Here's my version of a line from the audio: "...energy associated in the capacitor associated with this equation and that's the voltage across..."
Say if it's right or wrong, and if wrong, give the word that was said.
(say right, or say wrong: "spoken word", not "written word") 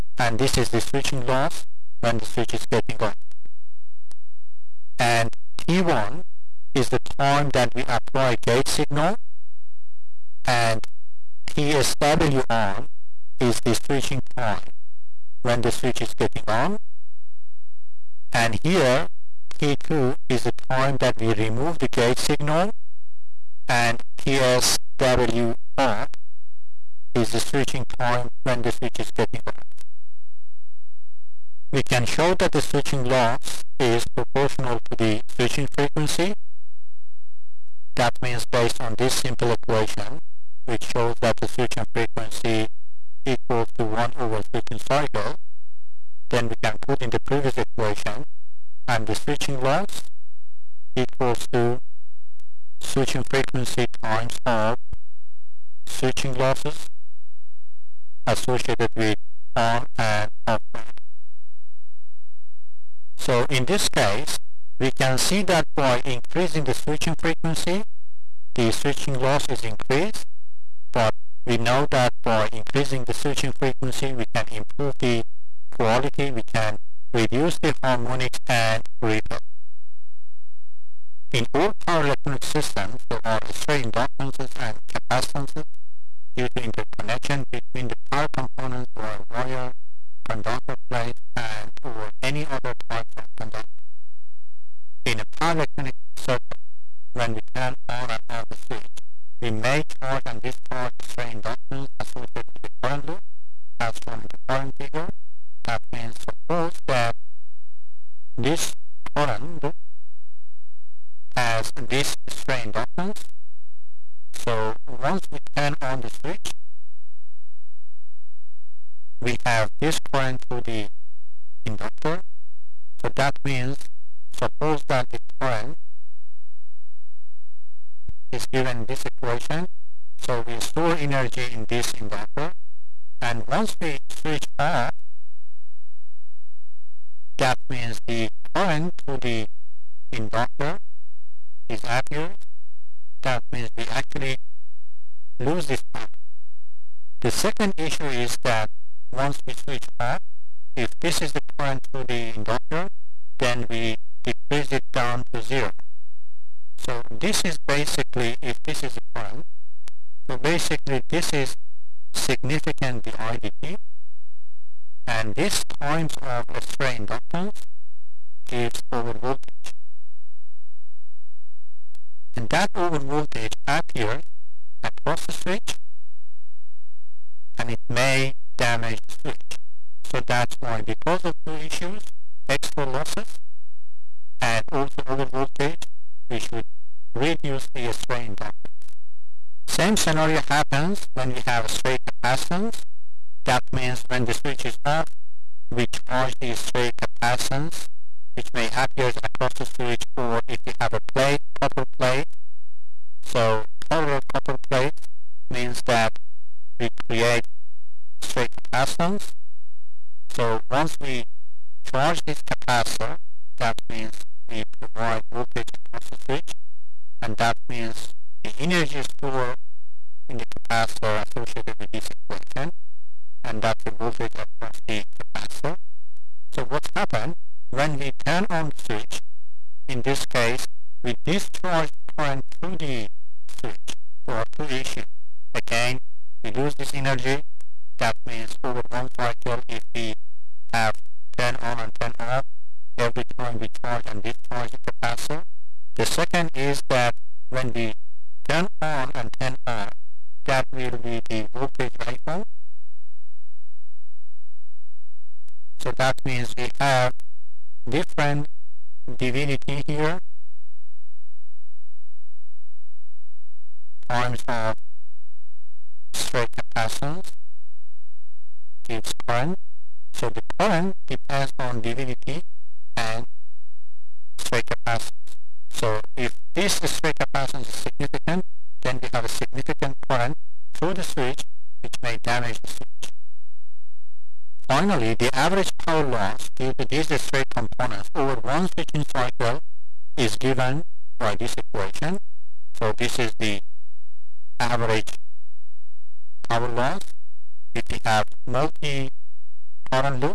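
wrong: "stored", not "associated".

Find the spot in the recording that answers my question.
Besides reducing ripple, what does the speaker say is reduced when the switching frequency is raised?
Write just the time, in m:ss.
1:17.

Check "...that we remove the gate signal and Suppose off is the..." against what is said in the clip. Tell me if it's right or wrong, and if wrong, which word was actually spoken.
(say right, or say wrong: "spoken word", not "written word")
wrong: "TSW", not "Suppose".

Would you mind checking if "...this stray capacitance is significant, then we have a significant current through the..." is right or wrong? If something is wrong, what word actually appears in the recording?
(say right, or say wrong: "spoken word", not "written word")
right.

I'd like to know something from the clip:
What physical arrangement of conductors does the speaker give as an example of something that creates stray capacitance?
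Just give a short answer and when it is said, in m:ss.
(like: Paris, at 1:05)
Parallel copper plates, at 3:23.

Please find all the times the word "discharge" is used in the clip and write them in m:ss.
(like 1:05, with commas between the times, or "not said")
1:40, 3:51, 4:04.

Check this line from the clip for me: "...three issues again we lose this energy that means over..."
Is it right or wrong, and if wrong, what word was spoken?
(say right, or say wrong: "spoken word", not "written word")
wrong: "two", not "three".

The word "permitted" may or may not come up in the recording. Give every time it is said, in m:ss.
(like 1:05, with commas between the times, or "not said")
not said.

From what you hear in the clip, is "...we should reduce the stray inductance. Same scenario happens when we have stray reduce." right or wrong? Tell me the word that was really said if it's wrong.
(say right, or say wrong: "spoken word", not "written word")
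wrong: "capacitance", not "reduce".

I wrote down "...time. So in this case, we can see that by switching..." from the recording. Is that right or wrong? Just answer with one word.
wrong.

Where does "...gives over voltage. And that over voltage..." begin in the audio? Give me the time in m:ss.
2:48.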